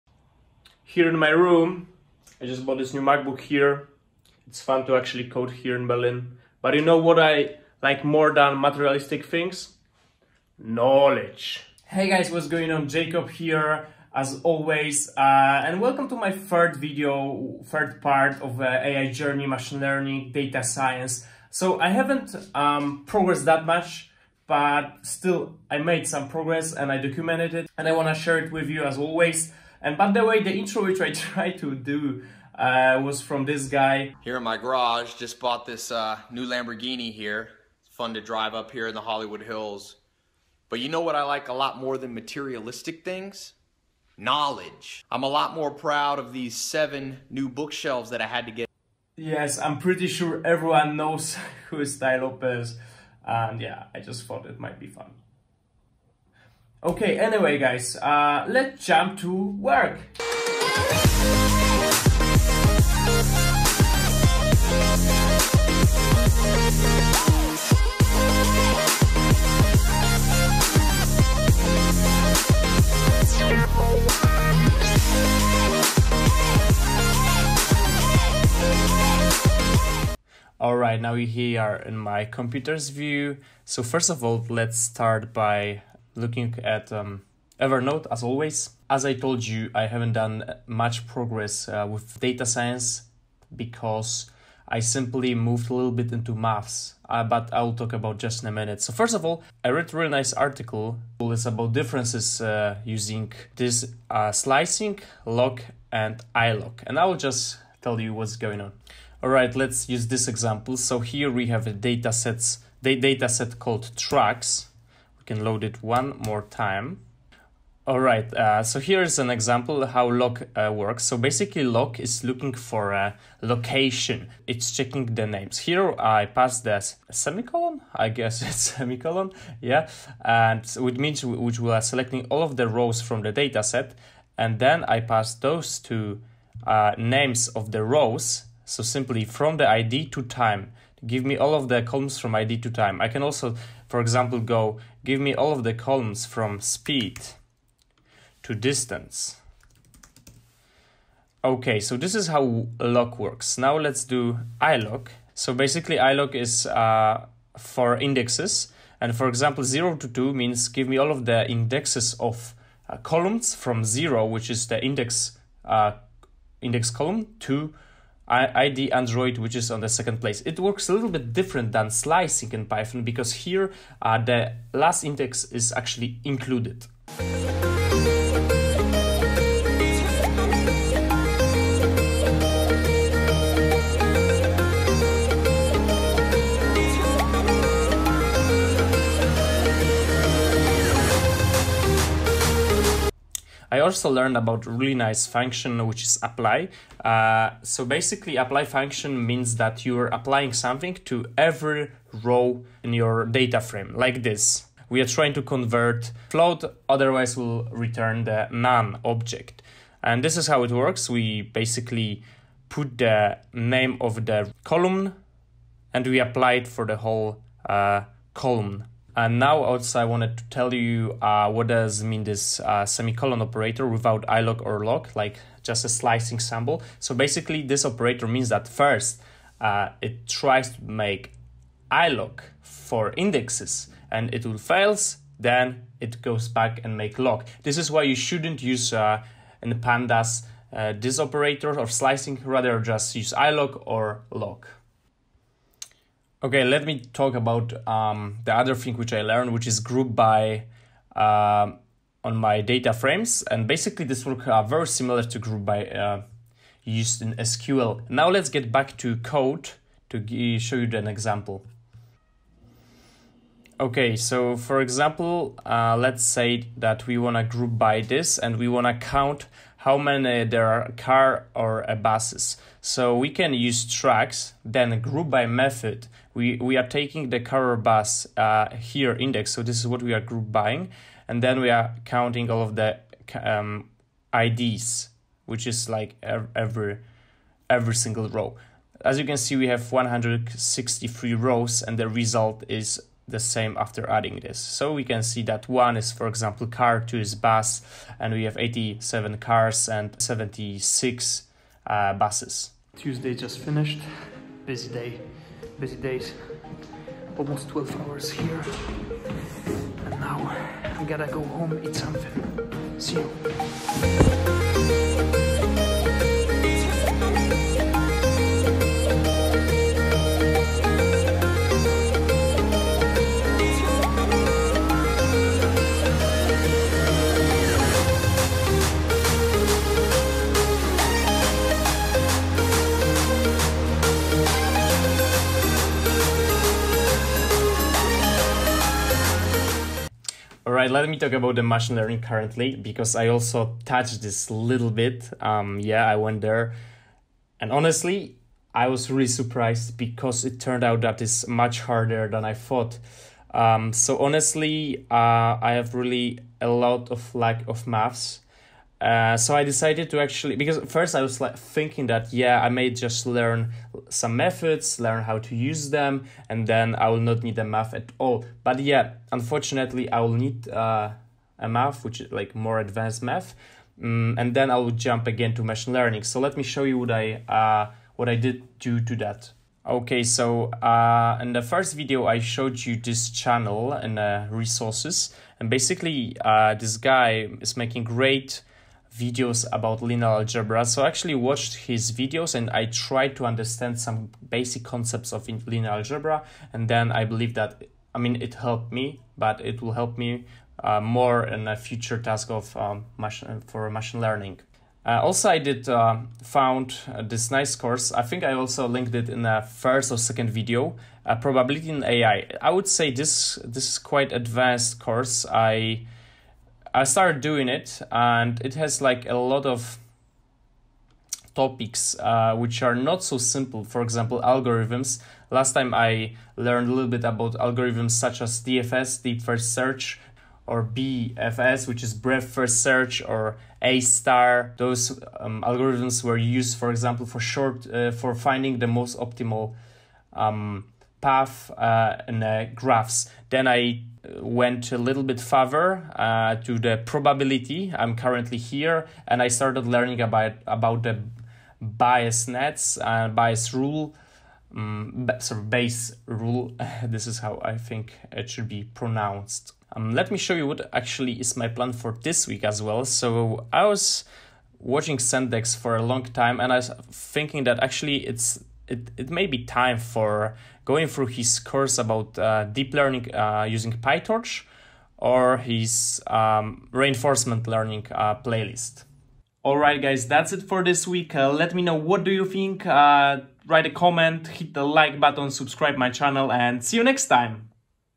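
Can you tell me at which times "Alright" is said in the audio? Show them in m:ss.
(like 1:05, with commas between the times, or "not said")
1:20.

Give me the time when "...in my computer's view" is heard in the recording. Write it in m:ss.
1:21.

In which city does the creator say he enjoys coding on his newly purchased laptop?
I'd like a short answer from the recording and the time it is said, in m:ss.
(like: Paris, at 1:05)
Berlin, at 0:05.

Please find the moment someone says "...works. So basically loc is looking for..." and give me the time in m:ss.
2:00.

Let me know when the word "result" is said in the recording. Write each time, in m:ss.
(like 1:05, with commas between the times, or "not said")
4:52.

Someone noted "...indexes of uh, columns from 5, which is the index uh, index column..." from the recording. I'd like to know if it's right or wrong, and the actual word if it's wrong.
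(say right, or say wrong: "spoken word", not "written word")
wrong: "0", not "5".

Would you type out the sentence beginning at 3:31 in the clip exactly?
We basically put the name of the column and we apply it for the whole uh, column.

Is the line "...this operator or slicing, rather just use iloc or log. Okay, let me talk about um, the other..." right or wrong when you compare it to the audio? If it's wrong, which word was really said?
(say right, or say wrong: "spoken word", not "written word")
right.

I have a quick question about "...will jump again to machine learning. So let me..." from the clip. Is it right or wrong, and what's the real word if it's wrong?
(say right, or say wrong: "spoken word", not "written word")
right.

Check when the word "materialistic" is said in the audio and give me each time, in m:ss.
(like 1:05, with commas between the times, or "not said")
0:08, 0:42.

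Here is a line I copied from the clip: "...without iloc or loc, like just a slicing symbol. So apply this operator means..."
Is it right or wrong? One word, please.
wrong.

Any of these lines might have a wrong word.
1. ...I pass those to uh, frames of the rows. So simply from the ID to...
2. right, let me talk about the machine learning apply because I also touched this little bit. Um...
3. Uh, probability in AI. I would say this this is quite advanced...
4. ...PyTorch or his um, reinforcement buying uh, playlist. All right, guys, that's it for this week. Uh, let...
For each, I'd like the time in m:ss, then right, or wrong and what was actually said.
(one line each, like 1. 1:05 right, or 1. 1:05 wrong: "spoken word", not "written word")
1. 2:14 wrong: "names", not "frames"
2. 5:40 wrong: "currently", not "apply"
3. 6:51 right
4. 7:54 wrong: "learning", not "buying".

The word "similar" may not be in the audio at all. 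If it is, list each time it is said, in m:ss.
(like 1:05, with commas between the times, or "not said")
4:14.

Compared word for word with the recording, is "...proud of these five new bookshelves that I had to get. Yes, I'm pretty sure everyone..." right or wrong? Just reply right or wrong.
wrong.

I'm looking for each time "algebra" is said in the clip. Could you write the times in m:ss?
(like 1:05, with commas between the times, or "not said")
6:30, 6:35.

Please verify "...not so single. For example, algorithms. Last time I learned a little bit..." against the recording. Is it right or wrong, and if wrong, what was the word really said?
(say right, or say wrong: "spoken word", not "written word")
wrong: "simple", not "single".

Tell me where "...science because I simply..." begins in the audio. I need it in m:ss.
1:32.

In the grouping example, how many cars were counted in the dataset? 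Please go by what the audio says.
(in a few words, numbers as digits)
87.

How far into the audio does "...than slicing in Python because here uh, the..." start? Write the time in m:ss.
2:51.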